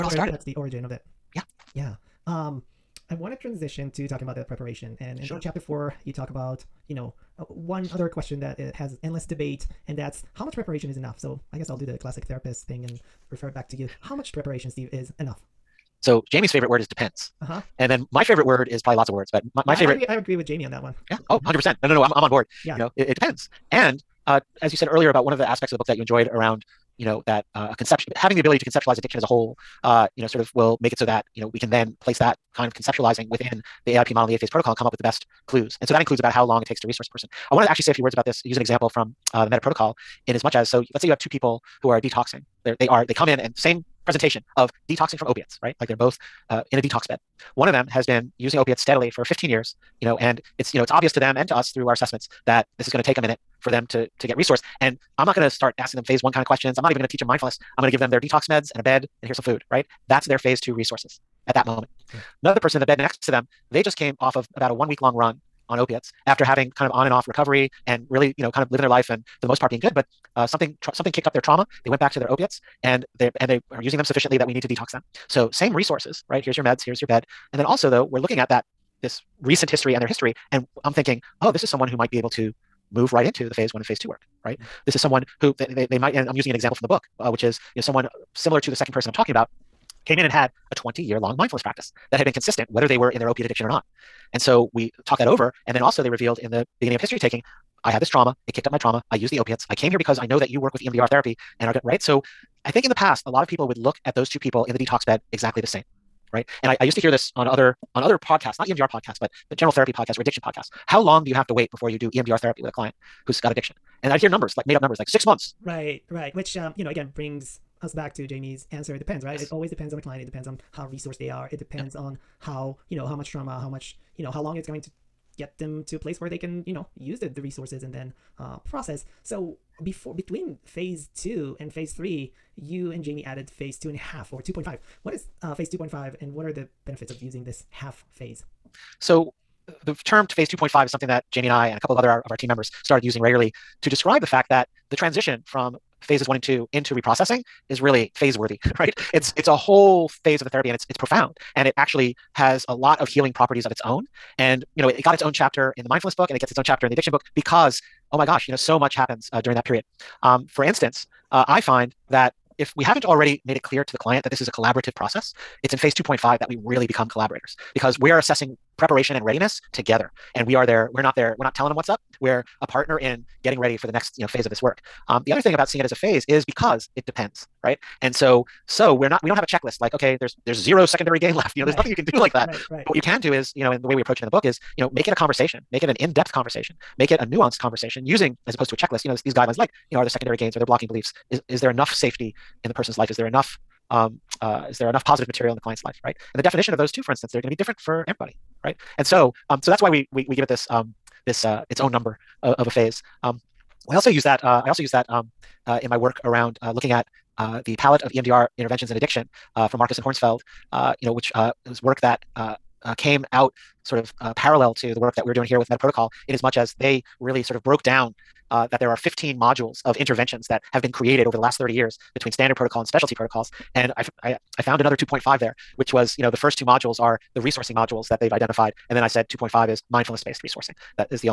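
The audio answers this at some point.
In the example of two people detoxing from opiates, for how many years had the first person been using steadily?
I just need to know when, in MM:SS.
00:49.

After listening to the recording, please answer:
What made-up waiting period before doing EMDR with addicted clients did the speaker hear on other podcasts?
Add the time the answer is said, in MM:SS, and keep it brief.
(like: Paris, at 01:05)
6 months, at 01:55.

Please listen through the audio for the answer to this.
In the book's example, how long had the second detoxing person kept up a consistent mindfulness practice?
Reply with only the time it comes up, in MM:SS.
01:30.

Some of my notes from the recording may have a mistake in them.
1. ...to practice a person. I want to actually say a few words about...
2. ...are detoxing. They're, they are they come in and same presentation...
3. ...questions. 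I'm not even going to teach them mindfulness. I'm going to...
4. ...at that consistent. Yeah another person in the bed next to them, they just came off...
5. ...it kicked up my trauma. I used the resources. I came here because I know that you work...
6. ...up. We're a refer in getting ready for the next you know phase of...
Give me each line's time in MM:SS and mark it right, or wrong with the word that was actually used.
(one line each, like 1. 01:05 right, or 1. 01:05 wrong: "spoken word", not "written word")
1. 00:36 wrong: "resource", not "practice"
2. 00:41 right
3. 00:56 right
4. 01:01 wrong: "moment", not "consistent"
5. 01:38 wrong: "opiates", not "resources"
6. 02:51 wrong: "partner", not "refer".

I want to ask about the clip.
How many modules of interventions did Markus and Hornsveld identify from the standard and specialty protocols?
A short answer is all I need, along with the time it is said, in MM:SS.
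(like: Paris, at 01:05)
15, at 03:38.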